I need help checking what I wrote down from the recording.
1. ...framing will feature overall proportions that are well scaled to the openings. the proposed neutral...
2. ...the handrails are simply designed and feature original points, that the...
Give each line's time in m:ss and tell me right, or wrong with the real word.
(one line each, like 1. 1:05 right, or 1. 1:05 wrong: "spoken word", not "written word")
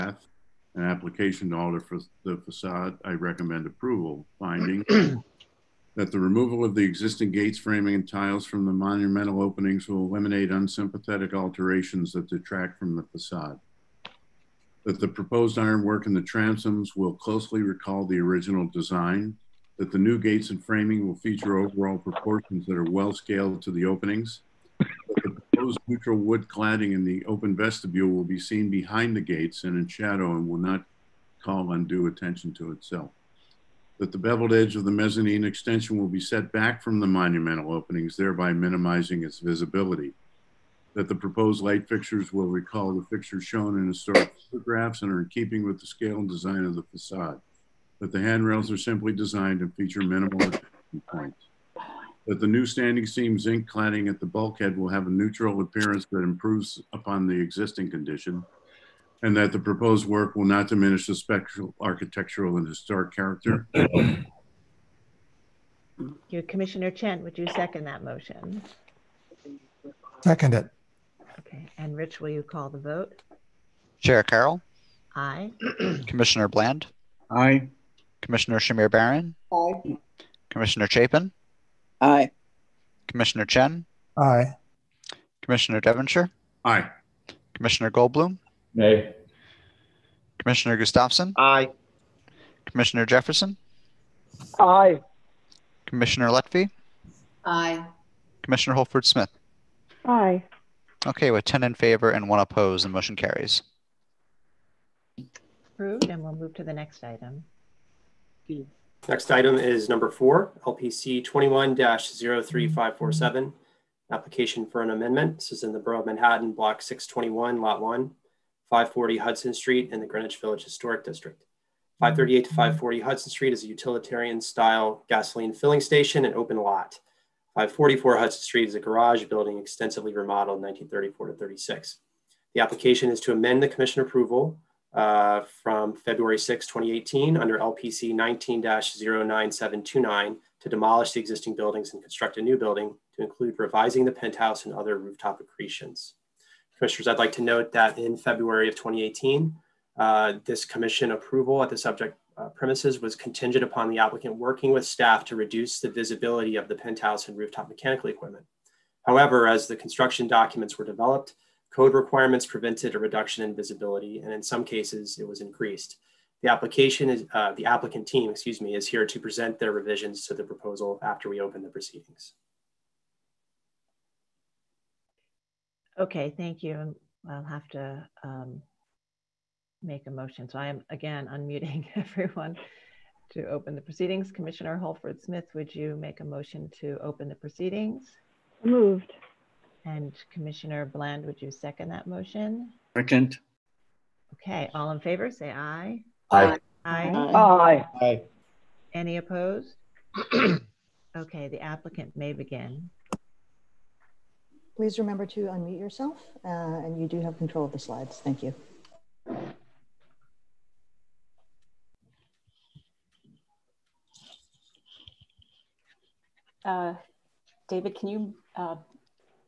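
1. 0:20 right
2. 0:48 wrong: "minimal", not "original".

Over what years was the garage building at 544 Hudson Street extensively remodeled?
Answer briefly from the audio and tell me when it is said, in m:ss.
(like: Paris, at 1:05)
1934 to 1936, at 2:10.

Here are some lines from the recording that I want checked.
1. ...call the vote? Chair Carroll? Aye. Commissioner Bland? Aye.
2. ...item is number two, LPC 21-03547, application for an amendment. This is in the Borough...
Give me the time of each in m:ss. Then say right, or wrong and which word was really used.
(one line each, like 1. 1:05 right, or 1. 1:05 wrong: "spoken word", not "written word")
1. 1:12 right
2. 1:49 wrong: "four", not "two".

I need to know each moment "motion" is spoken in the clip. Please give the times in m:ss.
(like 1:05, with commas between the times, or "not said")
1:08, 1:42, 3:00, 3:06, 3:12.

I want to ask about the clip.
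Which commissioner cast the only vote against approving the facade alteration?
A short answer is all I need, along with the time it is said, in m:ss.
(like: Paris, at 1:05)
Goldblum, at 1:27.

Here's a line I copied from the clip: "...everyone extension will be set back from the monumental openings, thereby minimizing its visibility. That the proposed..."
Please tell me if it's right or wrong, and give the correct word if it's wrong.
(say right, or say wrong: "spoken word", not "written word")
wrong: "mezzanine", not "everyone".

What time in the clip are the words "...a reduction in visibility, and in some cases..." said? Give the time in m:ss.
2:42.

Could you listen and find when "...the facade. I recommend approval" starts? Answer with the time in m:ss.
0:02.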